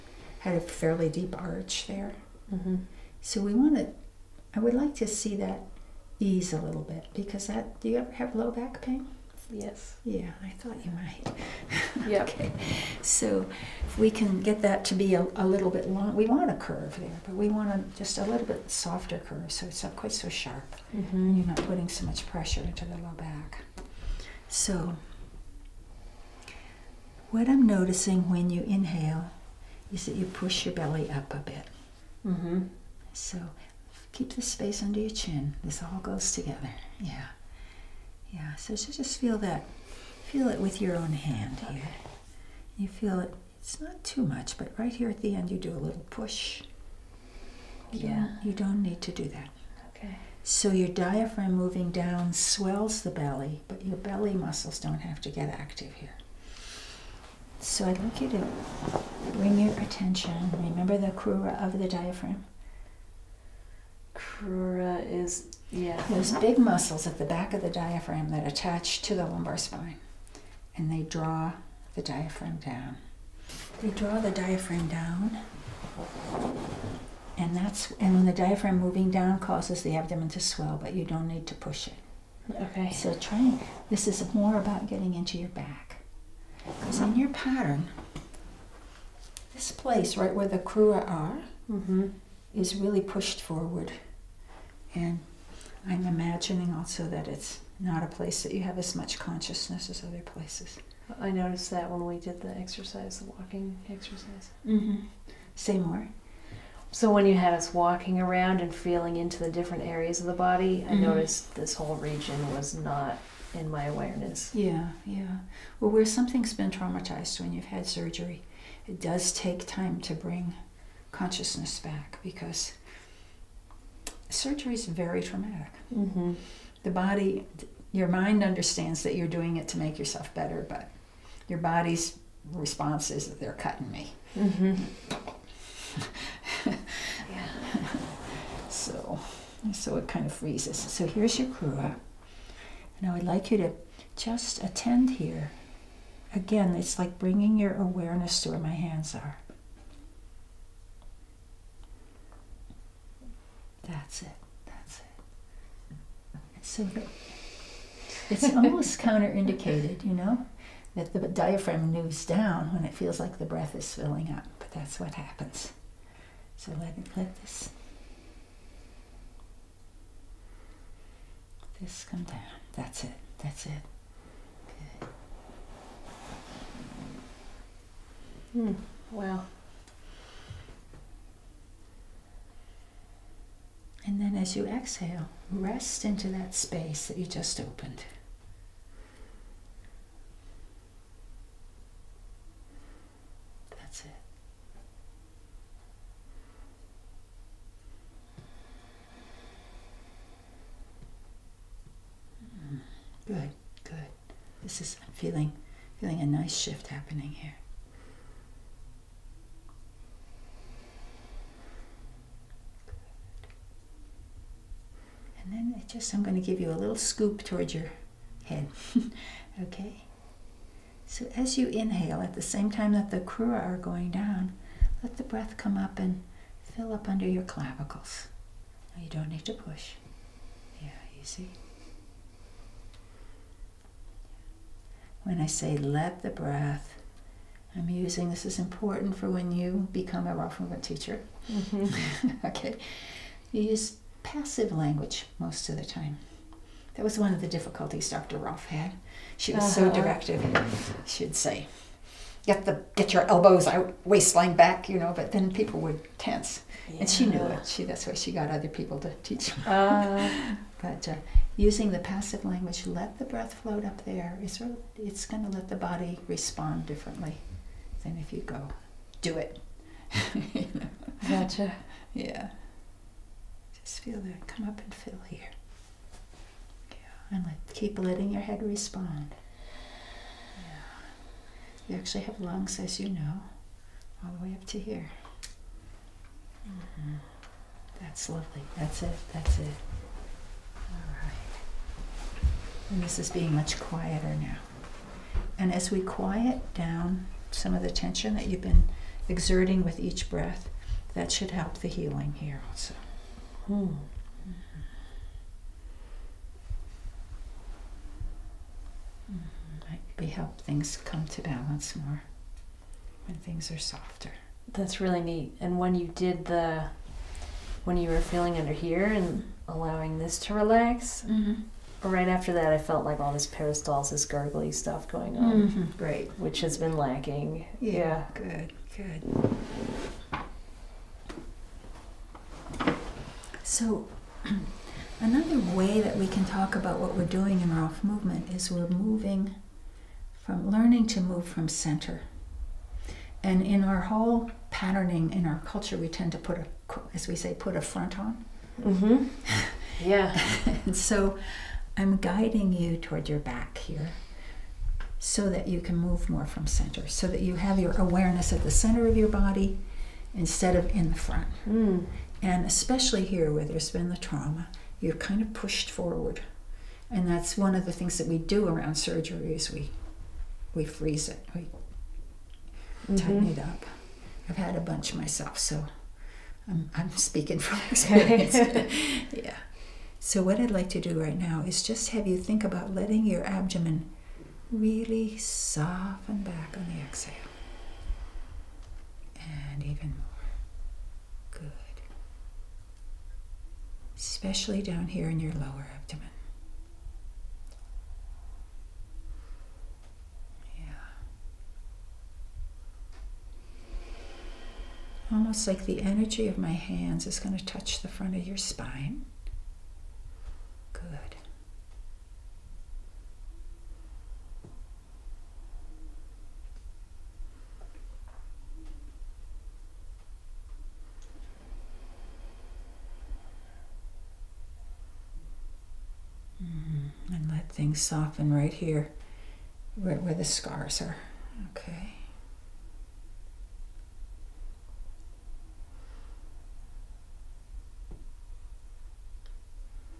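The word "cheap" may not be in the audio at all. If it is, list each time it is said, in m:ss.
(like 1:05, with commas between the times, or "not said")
not said.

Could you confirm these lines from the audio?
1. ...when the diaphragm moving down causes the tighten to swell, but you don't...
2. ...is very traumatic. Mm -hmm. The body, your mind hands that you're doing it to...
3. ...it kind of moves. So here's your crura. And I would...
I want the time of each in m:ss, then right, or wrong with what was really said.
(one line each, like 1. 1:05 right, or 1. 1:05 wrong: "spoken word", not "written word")
1. 1:18 wrong: "abdomen", not "tighten"
2. 2:04 wrong: "understands", not "hands"
3. 2:19 wrong: "freezes", not "moves".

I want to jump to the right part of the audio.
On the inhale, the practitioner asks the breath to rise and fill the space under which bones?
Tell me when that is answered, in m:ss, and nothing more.
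3:47.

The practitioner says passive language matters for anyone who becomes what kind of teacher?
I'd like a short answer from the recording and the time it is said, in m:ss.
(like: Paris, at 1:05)
Rolfing teacher, at 4:00.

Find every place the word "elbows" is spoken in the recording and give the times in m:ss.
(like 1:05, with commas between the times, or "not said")
4:13.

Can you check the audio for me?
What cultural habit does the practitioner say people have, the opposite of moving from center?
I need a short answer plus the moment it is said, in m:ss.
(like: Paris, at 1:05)
put a front on, at 5:47.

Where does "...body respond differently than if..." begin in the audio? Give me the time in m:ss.
4:25.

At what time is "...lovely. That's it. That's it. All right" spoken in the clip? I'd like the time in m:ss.
4:48.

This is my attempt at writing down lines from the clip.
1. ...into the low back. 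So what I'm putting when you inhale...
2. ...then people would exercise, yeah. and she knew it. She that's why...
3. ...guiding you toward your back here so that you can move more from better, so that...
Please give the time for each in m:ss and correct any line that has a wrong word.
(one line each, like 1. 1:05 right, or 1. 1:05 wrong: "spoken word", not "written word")
1. 0:22 wrong: "noticing", not "putting"
2. 4:15 wrong: "tense", not "exercise"
3. 5:52 wrong: "center", not "better".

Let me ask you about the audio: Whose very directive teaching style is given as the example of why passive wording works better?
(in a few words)
Dr. Rolf.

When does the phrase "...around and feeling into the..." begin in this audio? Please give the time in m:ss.
1:48.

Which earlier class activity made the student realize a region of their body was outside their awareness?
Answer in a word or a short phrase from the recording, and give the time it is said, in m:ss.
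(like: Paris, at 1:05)
walking exercise, at 1:43.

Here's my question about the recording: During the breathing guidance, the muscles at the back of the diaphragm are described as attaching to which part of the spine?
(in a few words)
lumbar spine.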